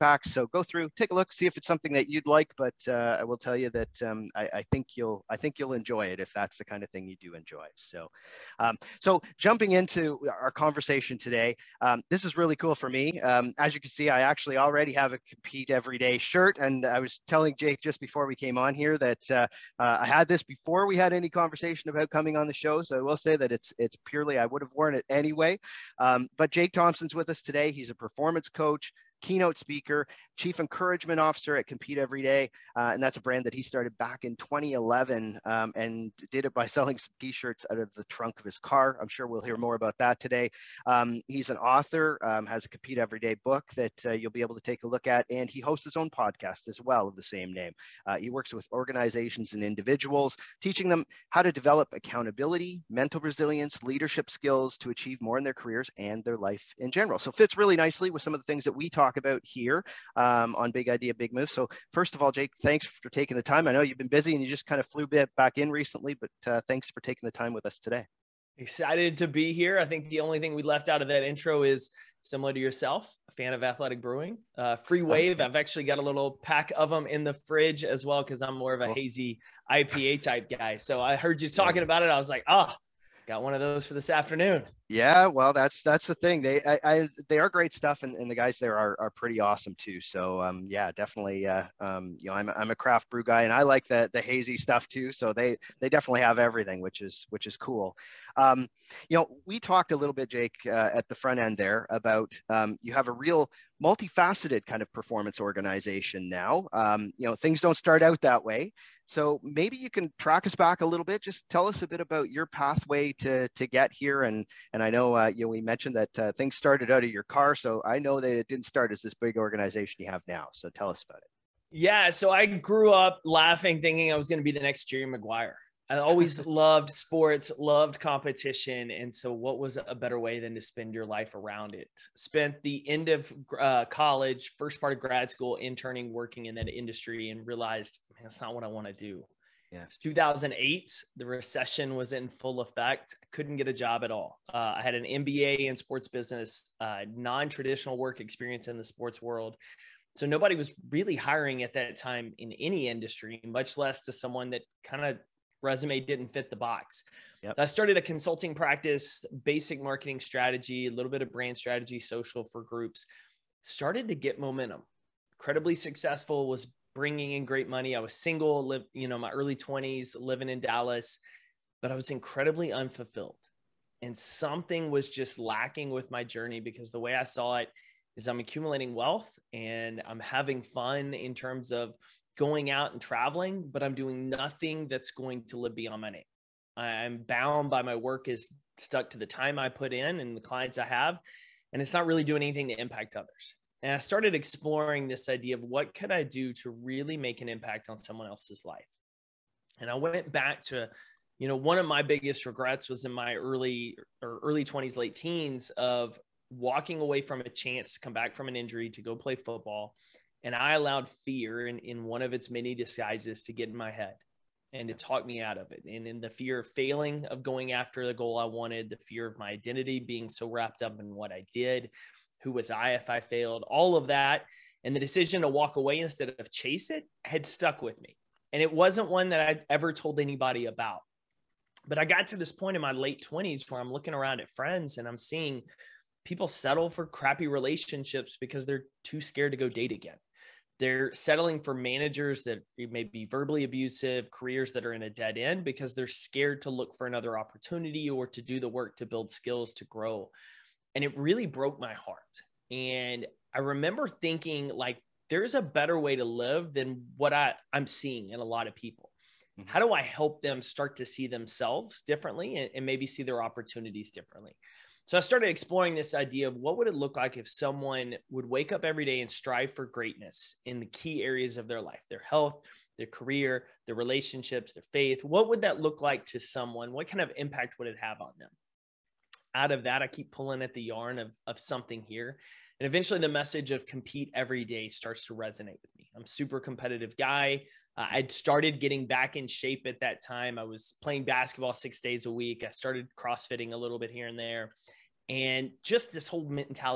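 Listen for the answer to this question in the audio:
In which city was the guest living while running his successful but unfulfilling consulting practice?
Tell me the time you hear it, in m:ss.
2:50.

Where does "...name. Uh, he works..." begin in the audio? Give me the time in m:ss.
0:47.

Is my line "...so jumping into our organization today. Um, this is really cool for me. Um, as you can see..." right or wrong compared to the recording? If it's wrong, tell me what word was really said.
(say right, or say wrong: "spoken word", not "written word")
wrong: "conversation", not "organization".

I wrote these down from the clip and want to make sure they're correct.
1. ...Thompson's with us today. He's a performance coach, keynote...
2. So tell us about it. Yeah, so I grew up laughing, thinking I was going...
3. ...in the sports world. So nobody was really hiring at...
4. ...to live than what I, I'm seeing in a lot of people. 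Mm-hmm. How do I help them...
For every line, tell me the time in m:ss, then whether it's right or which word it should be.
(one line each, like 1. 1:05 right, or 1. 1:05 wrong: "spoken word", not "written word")
1. 0:26 right
2. 2:00 right
3. 2:28 right
4. 4:16 right.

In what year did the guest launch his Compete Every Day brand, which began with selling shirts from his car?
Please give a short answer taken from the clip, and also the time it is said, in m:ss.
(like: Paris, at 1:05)
2011, at 0:34.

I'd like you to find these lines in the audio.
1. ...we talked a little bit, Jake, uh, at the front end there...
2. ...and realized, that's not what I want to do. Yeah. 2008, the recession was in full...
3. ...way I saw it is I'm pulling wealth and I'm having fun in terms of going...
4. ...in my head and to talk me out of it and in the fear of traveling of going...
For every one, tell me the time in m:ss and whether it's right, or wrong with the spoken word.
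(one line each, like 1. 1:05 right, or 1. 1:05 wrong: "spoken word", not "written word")
1. 1:39 right
2. 2:17 right
3. 2:57 wrong: "accumulating", not "pulling"
4. 3:33 wrong: "failing", not "traveling".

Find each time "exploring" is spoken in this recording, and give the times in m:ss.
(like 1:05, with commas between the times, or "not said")
3:14, 4:25.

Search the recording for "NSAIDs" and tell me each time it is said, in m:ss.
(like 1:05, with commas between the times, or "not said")
not said.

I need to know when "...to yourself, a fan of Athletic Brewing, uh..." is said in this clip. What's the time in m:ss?
1:12.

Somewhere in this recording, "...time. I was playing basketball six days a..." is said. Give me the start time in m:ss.
4:50.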